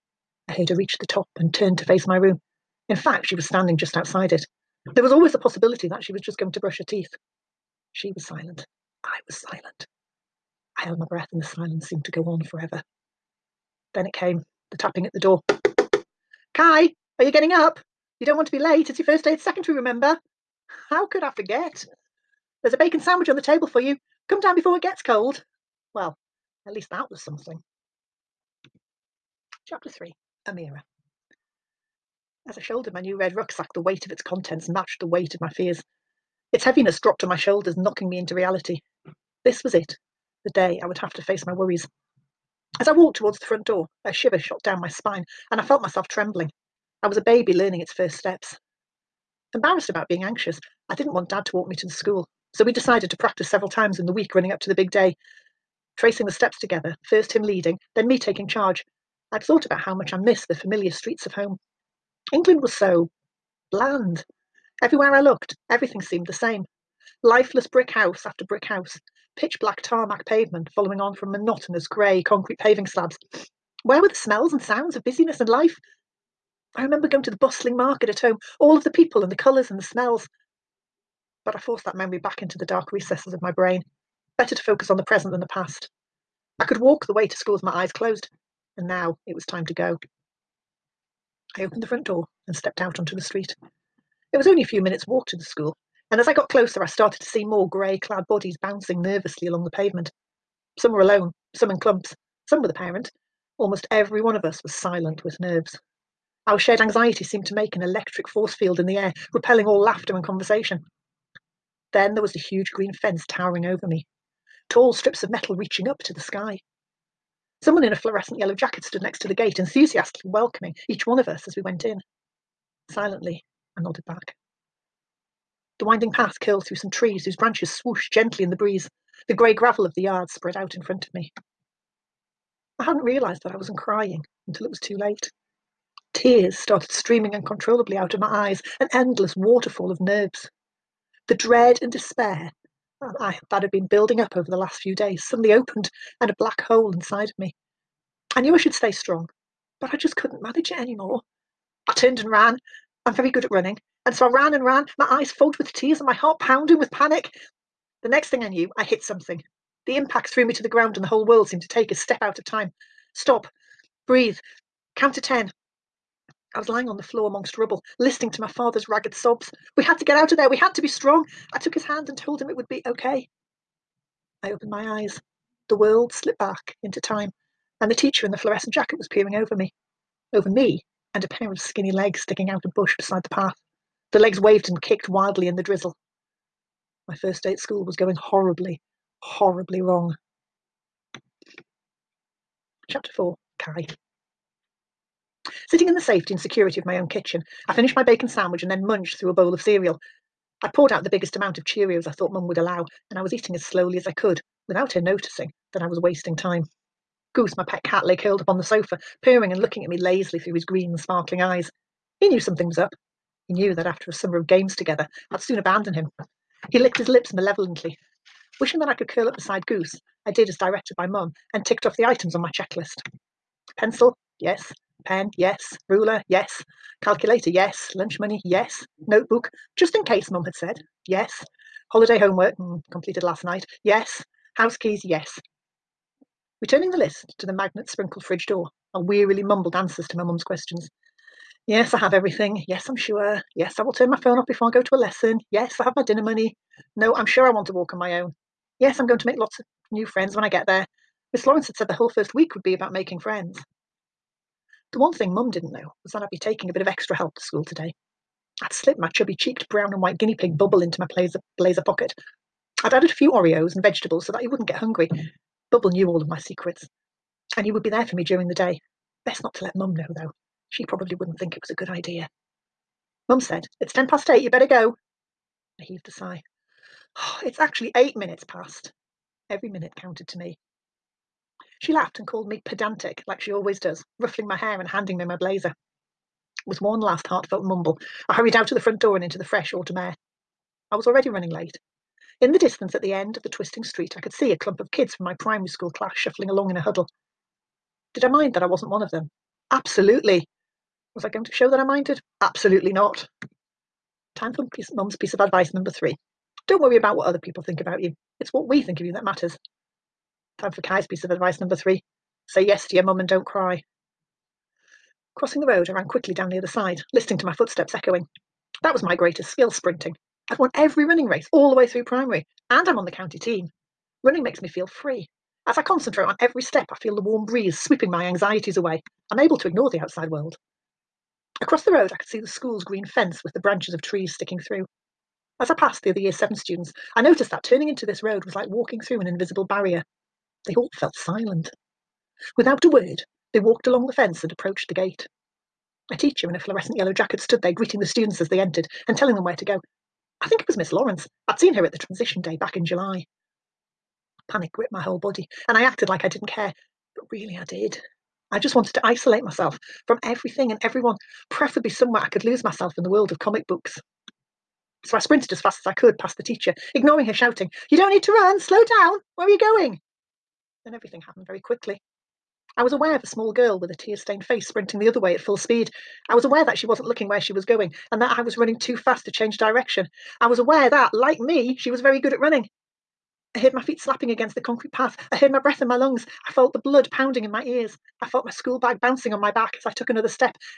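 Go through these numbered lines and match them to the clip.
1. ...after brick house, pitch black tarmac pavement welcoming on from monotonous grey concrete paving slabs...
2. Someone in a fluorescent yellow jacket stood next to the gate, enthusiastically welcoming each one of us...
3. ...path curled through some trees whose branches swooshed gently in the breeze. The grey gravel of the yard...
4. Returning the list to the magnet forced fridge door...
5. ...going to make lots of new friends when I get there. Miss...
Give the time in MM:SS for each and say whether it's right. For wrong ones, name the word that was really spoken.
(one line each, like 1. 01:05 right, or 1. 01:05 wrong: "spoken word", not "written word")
1. 01:08 wrong: "following", not "welcoming"
2. 01:57 right
3. 02:06 right
4. 03:56 wrong: "sprinkled", not "forced"
5. 04:09 right.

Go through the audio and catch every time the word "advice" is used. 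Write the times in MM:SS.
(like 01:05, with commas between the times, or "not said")
05:05, 05:11.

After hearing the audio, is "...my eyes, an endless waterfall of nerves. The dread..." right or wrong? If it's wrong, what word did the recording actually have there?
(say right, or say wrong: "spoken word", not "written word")
right.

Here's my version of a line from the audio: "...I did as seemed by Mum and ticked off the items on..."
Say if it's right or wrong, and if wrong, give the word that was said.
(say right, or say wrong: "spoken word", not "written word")
wrong: "directed", not "seemed".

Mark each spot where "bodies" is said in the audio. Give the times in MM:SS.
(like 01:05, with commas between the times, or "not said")
01:38.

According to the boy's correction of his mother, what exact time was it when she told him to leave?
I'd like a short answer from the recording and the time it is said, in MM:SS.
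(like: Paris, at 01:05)
8:08, at 04:37.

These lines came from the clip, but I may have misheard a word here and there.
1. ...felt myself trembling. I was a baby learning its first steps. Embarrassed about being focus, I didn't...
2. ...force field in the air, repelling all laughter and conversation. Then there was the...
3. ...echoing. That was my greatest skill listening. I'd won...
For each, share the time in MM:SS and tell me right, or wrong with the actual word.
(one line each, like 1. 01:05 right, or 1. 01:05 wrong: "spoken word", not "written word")
1. 00:45 wrong: "anxious", not "focus"
2. 01:48 right
3. 05:17 wrong: "sprinting", not "listening".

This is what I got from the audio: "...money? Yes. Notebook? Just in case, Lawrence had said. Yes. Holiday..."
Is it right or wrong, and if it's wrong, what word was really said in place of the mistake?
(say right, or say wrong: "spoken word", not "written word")
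wrong: "Mum", not "Lawrence".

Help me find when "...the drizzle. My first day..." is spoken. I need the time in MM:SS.
03:05.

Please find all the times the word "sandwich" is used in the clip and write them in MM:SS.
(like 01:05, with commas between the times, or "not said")
00:22, 03:18.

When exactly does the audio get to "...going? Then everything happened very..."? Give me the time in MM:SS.
06:09.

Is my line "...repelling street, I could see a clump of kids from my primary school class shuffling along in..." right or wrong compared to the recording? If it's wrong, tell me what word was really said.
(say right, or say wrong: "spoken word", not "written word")
wrong: "twisting", not "repelling".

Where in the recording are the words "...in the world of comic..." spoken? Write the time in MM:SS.
06:02.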